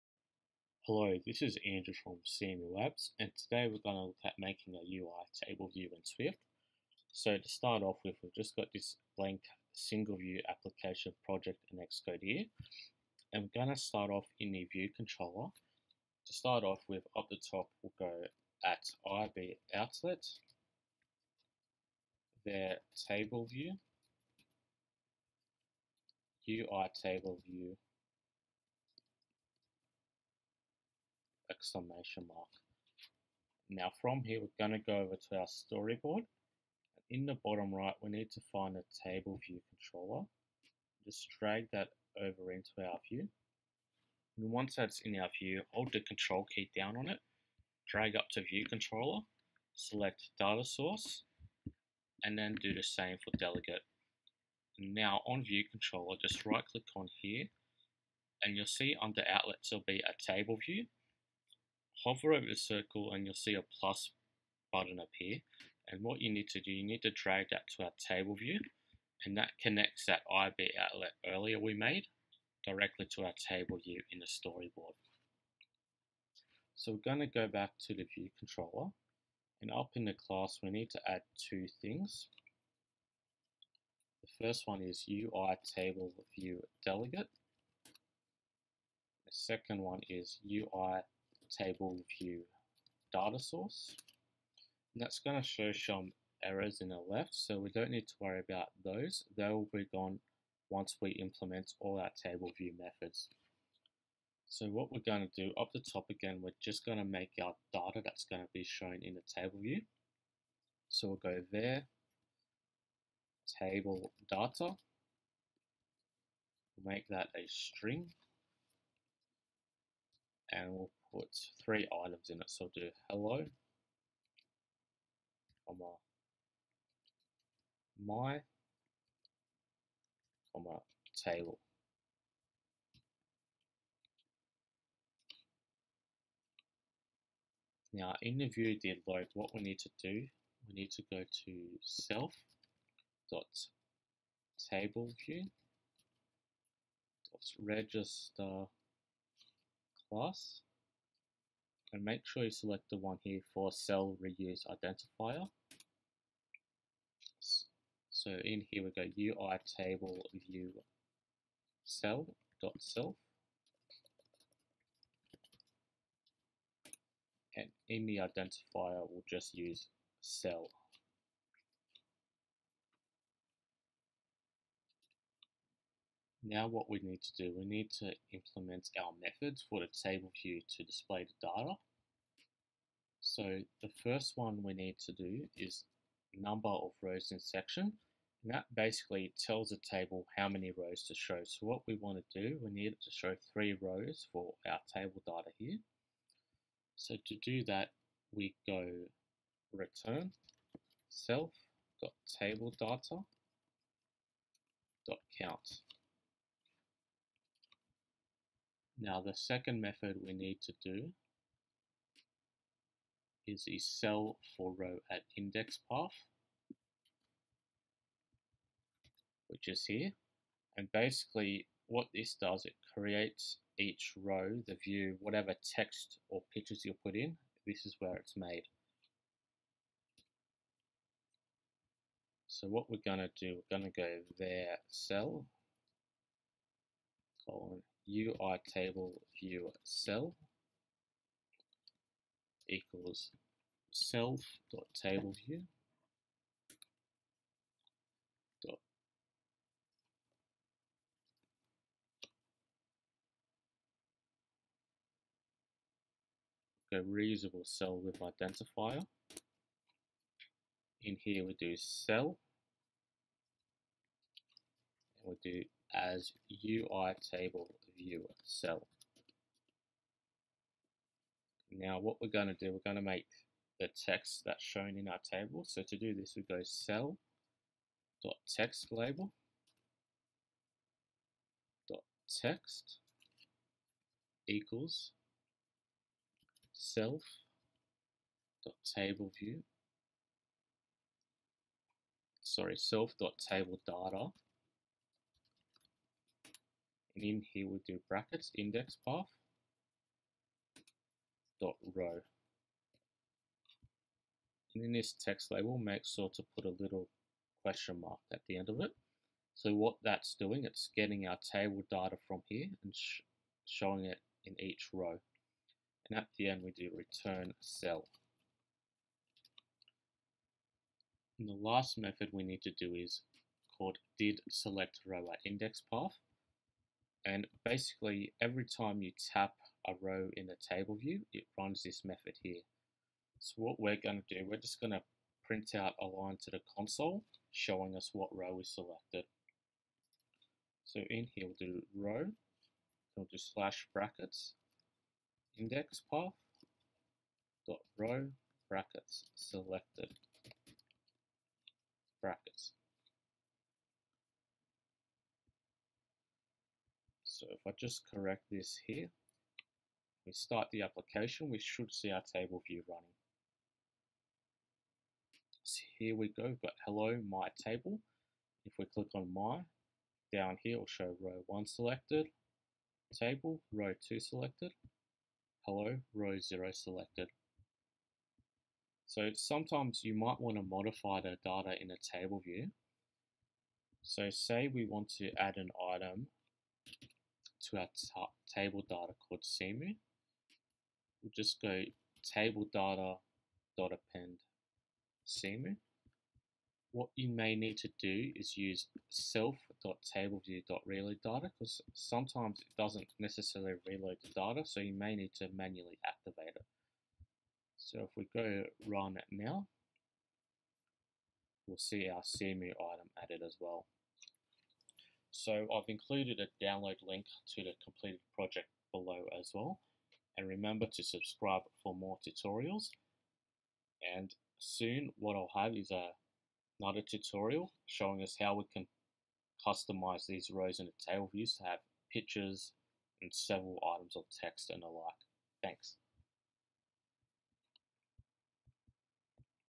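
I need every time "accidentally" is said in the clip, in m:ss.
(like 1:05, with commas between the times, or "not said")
not said.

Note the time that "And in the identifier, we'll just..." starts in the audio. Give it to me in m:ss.
2:47.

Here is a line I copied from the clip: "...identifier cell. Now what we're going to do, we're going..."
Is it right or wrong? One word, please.
wrong.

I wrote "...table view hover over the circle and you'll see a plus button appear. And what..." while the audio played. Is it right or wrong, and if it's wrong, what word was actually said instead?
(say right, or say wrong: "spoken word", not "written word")
right.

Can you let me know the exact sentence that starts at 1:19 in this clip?
And up in the class, we need to add two things.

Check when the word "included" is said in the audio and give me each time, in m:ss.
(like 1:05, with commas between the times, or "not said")
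6:55.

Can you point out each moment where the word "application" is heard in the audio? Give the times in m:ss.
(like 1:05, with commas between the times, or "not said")
0:10, 6:00.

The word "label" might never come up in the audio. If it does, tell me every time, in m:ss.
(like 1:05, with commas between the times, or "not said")
4:38, 5:05.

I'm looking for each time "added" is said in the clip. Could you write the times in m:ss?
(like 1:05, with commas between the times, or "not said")
6:53.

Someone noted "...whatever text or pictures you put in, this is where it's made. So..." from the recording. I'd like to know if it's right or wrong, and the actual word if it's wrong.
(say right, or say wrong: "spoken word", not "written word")
right.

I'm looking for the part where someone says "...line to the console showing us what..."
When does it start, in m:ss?
5:36.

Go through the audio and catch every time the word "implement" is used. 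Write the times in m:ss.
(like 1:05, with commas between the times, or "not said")
1:41, 2:58.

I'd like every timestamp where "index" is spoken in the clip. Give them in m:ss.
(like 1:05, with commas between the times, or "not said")
3:35, 4:58, 5:25, 5:45.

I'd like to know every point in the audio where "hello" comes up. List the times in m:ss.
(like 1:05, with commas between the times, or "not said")
0:00, 2:03, 6:06, 6:15.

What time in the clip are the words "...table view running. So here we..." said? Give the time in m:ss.
6:02.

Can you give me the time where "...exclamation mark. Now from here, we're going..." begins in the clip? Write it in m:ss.
0:31.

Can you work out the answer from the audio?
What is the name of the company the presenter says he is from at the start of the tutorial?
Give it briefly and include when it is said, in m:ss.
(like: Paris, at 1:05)
Seemu Labs, at 0:02.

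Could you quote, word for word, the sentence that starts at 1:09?
And that connects that IB outlet earlier we made directly to our table view in the storyboard.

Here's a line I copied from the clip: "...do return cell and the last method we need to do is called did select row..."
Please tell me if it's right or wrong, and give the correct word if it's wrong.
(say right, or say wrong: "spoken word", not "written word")
right.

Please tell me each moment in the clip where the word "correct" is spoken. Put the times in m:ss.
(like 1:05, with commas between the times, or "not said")
5:58.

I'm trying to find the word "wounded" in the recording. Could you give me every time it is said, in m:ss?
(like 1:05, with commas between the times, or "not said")
not said.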